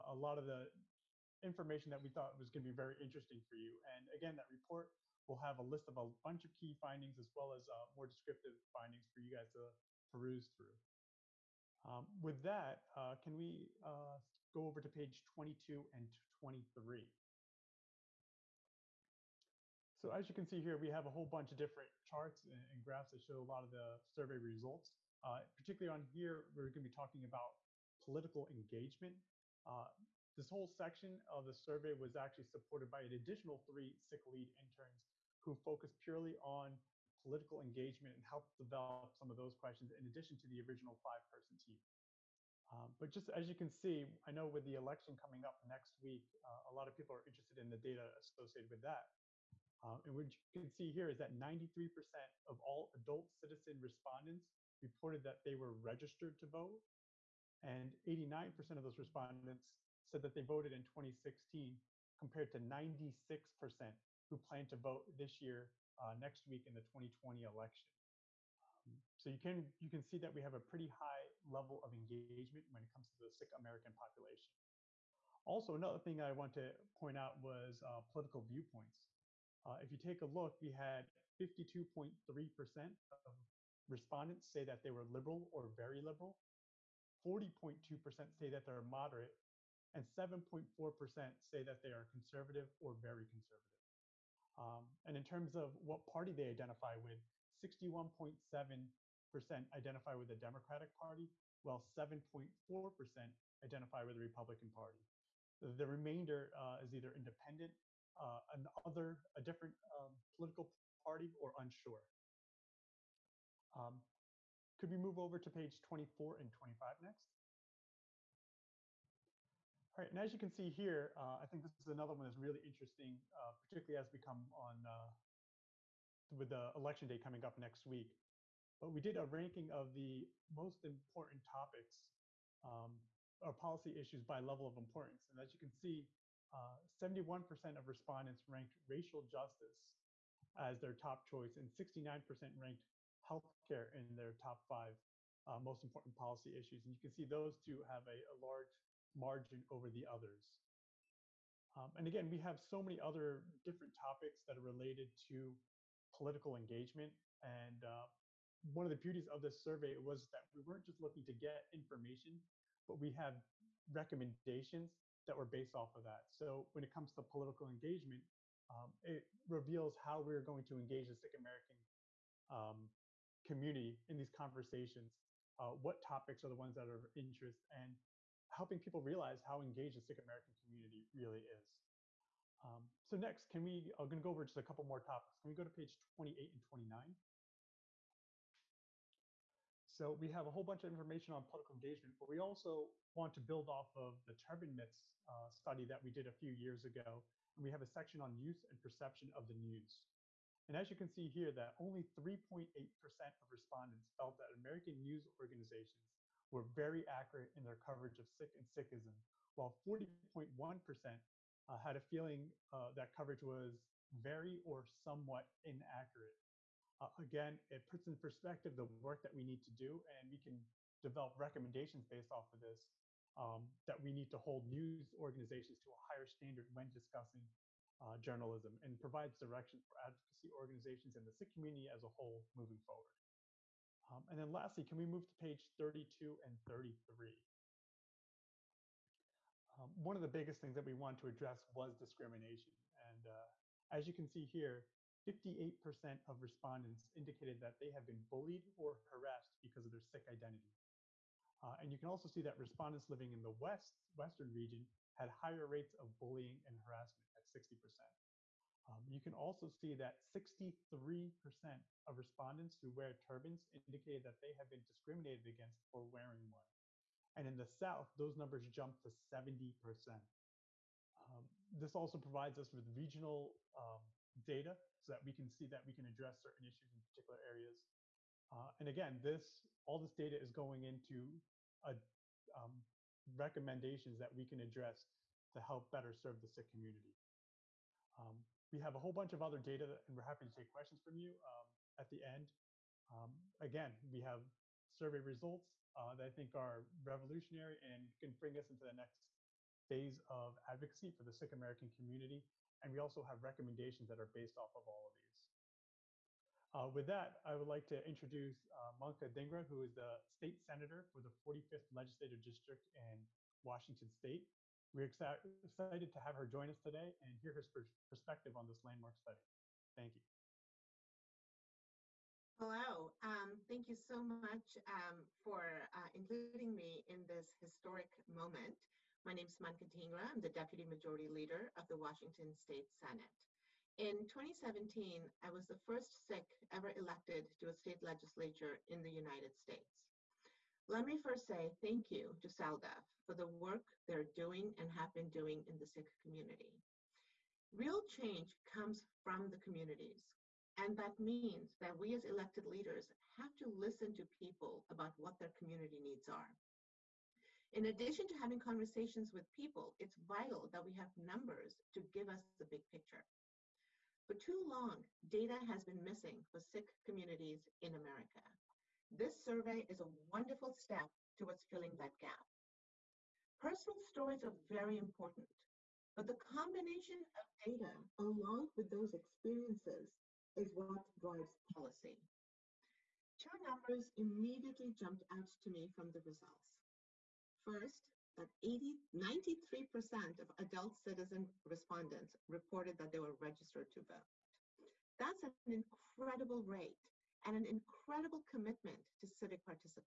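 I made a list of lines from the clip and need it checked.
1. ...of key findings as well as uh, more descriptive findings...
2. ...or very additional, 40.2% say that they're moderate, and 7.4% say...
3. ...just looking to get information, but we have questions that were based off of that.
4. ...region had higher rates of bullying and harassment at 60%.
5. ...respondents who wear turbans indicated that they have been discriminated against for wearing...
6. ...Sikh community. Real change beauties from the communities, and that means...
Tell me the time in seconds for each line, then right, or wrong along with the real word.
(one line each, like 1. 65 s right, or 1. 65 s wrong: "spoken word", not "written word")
1. 6 s right
2. 85 s wrong: "liberal", not "additional"
3. 160 s wrong: "recommendations", not "questions"
4. 254 s right
5. 262 s right
6. 345 s wrong: "comes", not "beauties".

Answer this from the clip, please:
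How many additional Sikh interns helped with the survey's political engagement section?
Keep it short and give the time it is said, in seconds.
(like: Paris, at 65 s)
3, at 33 s.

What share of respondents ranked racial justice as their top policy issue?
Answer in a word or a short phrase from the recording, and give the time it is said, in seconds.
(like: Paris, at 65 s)
71%, at 136 s.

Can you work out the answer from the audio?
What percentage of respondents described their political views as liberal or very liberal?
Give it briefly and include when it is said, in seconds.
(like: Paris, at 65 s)
52.3%, at 81 s.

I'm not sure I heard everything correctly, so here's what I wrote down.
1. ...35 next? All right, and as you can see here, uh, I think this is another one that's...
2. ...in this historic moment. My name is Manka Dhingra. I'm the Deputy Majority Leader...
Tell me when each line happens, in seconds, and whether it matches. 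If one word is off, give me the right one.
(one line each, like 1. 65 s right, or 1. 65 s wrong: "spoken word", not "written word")
1. 116 s wrong: "25", not "35"
2. 327 s right.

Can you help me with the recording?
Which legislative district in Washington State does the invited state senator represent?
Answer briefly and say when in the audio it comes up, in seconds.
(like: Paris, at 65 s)
45th, at 311 s.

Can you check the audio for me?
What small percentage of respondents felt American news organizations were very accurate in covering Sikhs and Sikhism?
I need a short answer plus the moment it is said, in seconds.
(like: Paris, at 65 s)
3.8%, at 202 s.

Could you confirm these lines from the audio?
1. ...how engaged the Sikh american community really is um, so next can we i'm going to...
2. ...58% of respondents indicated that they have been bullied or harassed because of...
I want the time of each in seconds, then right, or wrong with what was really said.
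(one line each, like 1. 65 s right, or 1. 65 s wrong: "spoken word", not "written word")
1. 179 s right
2. 245 s right.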